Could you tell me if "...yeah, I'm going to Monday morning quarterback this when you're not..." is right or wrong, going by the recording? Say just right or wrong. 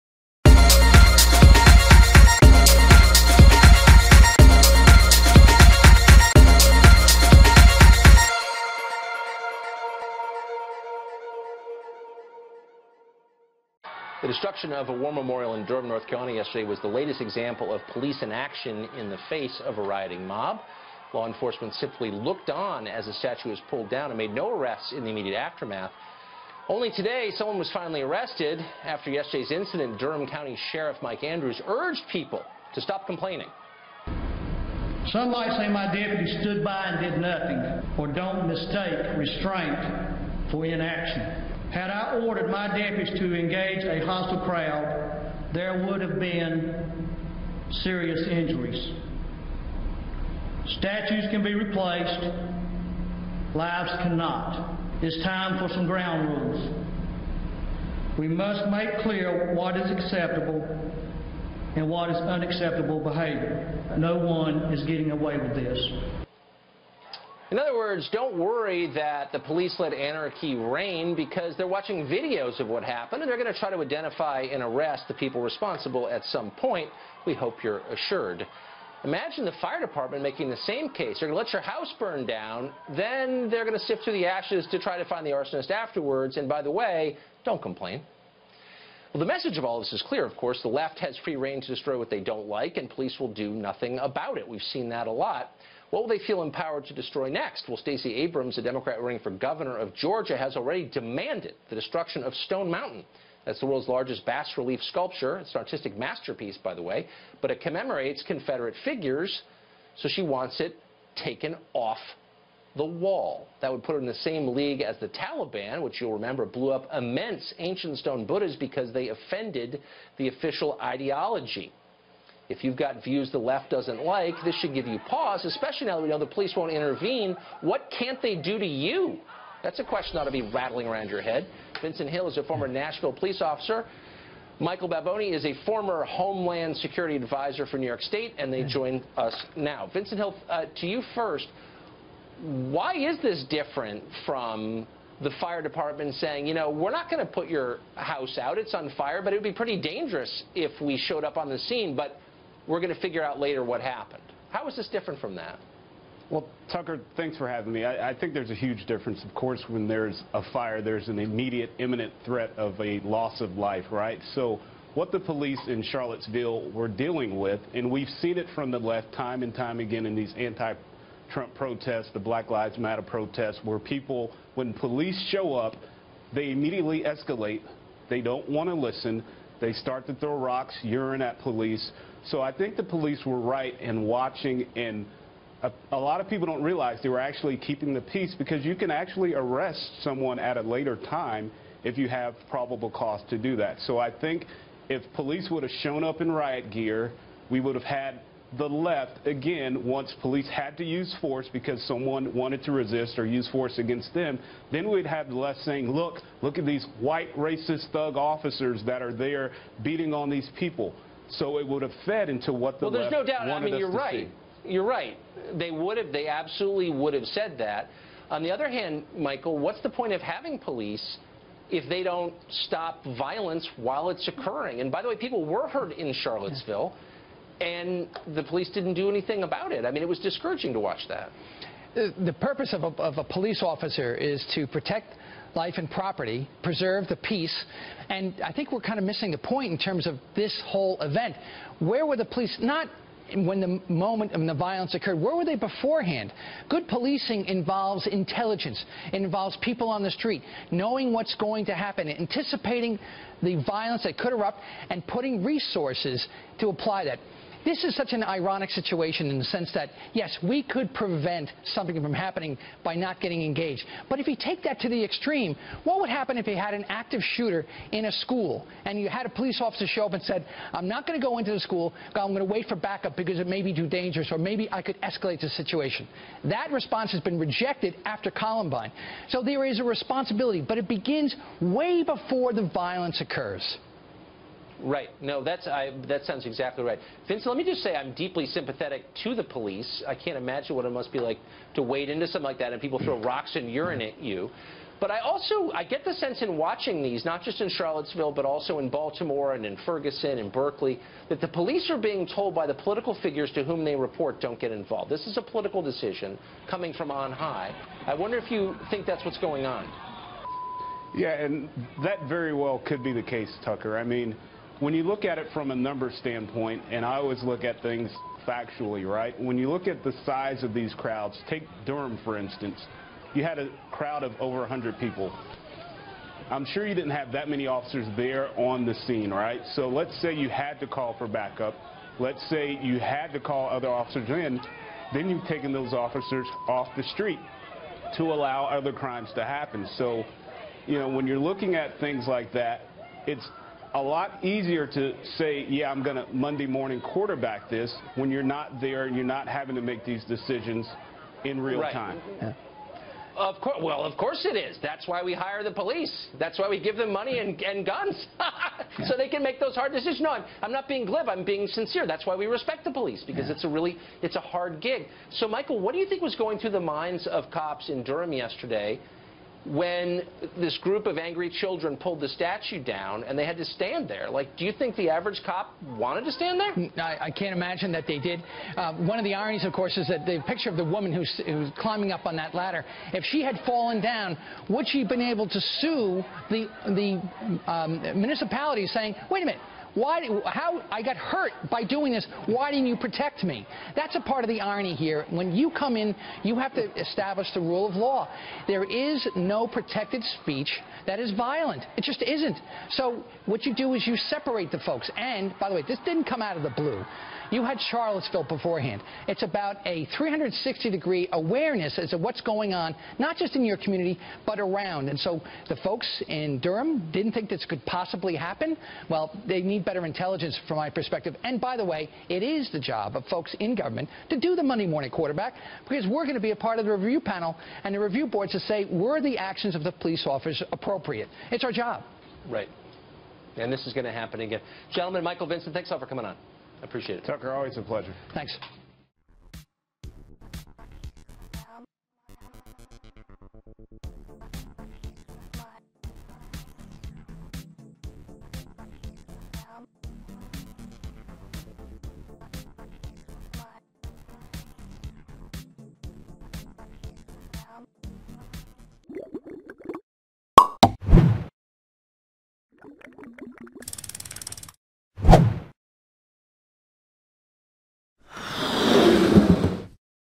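right.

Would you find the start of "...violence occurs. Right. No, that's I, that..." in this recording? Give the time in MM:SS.
04:42.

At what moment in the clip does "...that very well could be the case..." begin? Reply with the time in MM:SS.
05:12.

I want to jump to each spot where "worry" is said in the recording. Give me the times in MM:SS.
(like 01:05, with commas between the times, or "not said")
01:08.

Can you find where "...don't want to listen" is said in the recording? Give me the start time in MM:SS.
02:58.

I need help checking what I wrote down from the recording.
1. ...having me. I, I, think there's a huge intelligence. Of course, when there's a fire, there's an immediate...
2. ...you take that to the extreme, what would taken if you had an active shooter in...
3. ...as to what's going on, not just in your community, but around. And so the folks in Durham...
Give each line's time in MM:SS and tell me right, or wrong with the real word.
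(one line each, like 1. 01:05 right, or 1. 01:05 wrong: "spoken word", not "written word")
1. 02:37 wrong: "difference", not "intelligence"
2. 04:24 wrong: "happen", not "taken"
3. 06:51 right.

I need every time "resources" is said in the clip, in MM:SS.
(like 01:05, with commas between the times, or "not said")
04:15.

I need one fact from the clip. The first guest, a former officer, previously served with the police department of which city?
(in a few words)
Nashville.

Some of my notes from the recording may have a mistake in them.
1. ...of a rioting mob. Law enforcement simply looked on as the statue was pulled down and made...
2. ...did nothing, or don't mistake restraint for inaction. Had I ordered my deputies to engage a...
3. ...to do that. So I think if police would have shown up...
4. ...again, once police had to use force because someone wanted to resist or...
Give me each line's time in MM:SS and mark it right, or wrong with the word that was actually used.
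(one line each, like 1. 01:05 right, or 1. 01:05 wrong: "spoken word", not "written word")
1. 00:19 right
2. 00:36 right
3. 03:13 right
4. 03:19 right.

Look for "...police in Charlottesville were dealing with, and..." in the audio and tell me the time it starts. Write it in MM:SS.
02:45.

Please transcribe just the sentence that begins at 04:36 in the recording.
That response has been rejected after Columbine.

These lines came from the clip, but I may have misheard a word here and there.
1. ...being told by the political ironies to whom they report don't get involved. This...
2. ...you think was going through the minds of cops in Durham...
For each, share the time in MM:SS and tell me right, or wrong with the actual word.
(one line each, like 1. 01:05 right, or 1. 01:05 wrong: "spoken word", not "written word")
1. 05:01 wrong: "figures", not "ironies"
2. 06:05 right.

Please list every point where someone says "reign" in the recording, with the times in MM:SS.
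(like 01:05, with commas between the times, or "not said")
01:10, 01:31.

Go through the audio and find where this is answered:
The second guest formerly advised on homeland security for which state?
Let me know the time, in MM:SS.
02:17.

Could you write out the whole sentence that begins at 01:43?
That's the world's largest bas relief sculpture.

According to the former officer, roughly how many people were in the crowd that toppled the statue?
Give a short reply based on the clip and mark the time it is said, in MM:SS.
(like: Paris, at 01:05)
over 100, at 05:24.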